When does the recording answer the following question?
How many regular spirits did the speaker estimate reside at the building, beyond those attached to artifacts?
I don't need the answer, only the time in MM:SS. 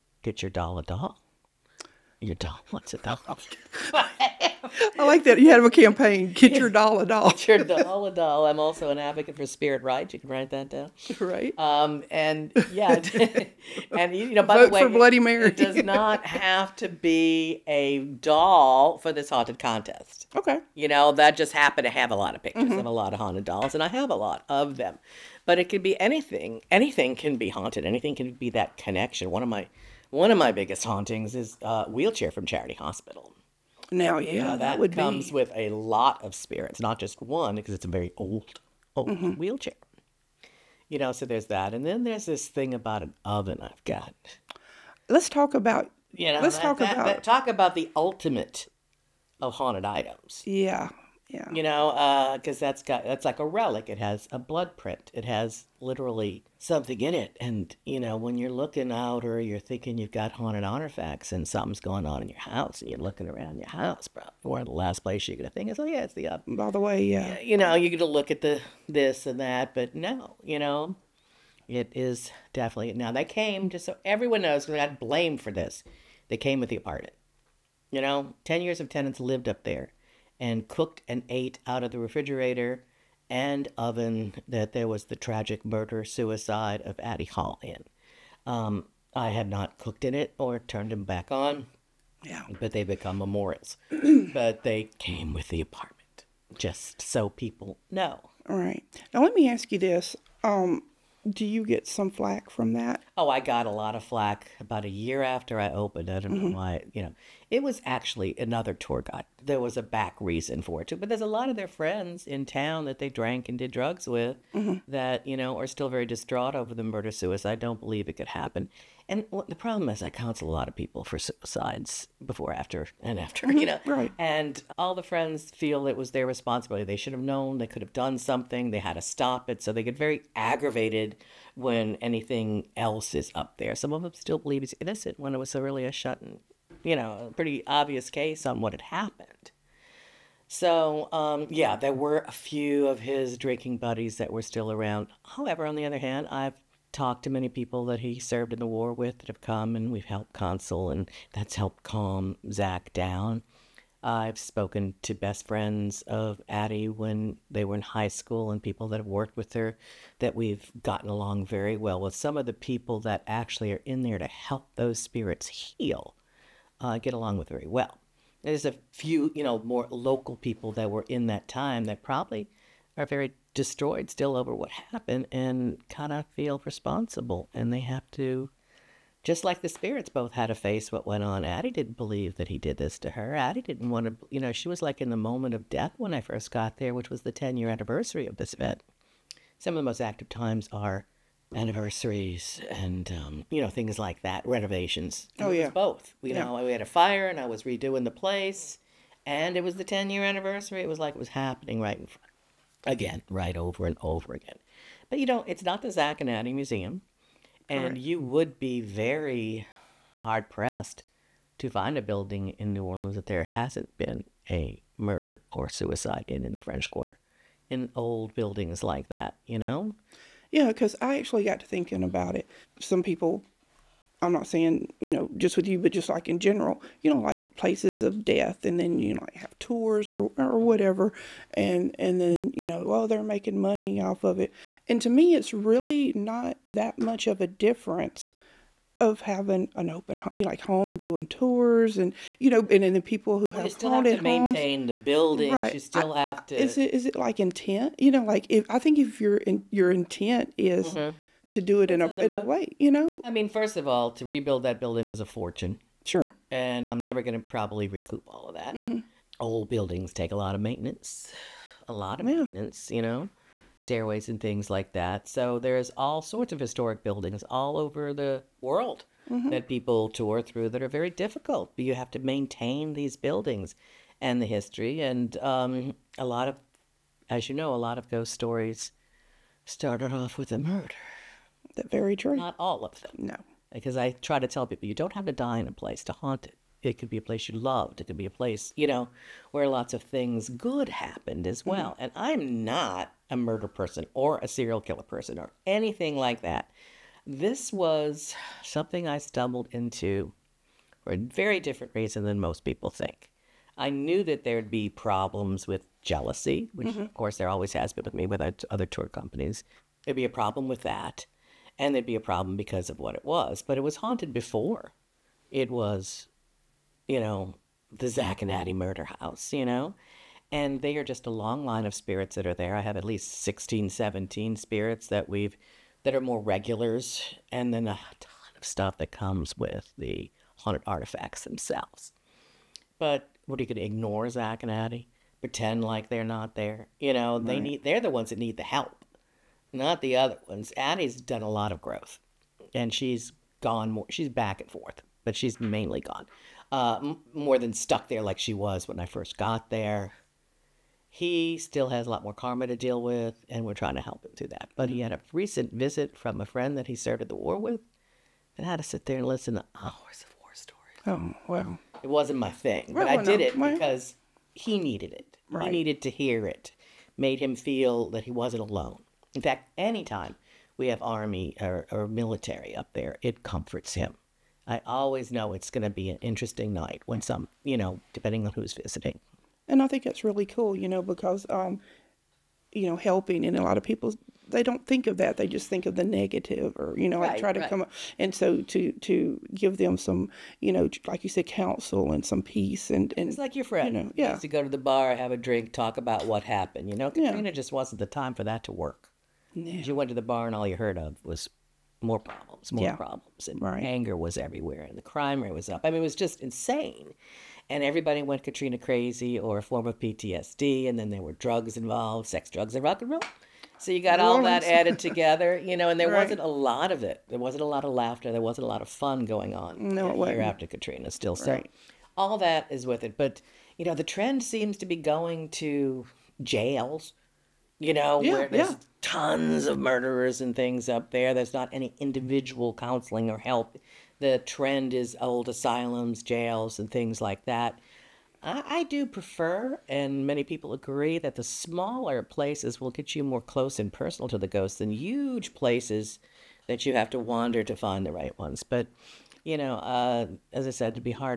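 05:23.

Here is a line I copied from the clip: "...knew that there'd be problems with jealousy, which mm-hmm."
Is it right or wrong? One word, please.
right.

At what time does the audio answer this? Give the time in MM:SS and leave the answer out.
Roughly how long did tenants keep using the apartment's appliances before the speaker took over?
01:18.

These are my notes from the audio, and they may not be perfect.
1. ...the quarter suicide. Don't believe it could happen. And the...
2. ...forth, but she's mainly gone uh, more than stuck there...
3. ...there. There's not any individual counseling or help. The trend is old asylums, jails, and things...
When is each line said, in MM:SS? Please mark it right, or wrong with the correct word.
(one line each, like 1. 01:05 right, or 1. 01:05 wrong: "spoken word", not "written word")
1. 01:56 wrong: "murder", not "quarter"
2. 05:44 right
3. 07:11 right.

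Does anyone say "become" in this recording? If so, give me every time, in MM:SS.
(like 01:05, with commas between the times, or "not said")
01:32.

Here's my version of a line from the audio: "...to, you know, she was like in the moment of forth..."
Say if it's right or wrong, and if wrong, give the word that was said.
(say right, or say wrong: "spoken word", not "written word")
wrong: "death", not "forth".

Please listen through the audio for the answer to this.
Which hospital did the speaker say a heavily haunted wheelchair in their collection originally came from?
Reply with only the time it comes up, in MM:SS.
00:32.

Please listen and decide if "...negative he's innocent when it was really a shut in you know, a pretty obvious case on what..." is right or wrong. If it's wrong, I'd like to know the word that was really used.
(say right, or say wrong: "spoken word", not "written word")
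wrong: "believe", not "negative".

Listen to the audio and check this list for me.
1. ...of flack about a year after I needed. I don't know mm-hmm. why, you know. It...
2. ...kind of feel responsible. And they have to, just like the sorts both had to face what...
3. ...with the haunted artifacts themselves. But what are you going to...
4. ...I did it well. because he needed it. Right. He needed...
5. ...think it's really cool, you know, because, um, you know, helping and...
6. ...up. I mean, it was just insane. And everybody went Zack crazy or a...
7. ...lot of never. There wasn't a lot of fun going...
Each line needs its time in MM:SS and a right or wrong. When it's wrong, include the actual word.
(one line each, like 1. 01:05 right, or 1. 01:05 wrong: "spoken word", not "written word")
1. 01:43 wrong: "opened", not "needed"
2. 02:55 wrong: "spirits", not "sorts"
3. 05:29 right
4. 06:03 right
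5. 06:19 right
6. 06:45 wrong: "Katrina", not "Zack"
7. 06:57 wrong: "laughter", not "never".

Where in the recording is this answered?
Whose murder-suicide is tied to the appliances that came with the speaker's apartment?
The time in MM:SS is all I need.
01:26.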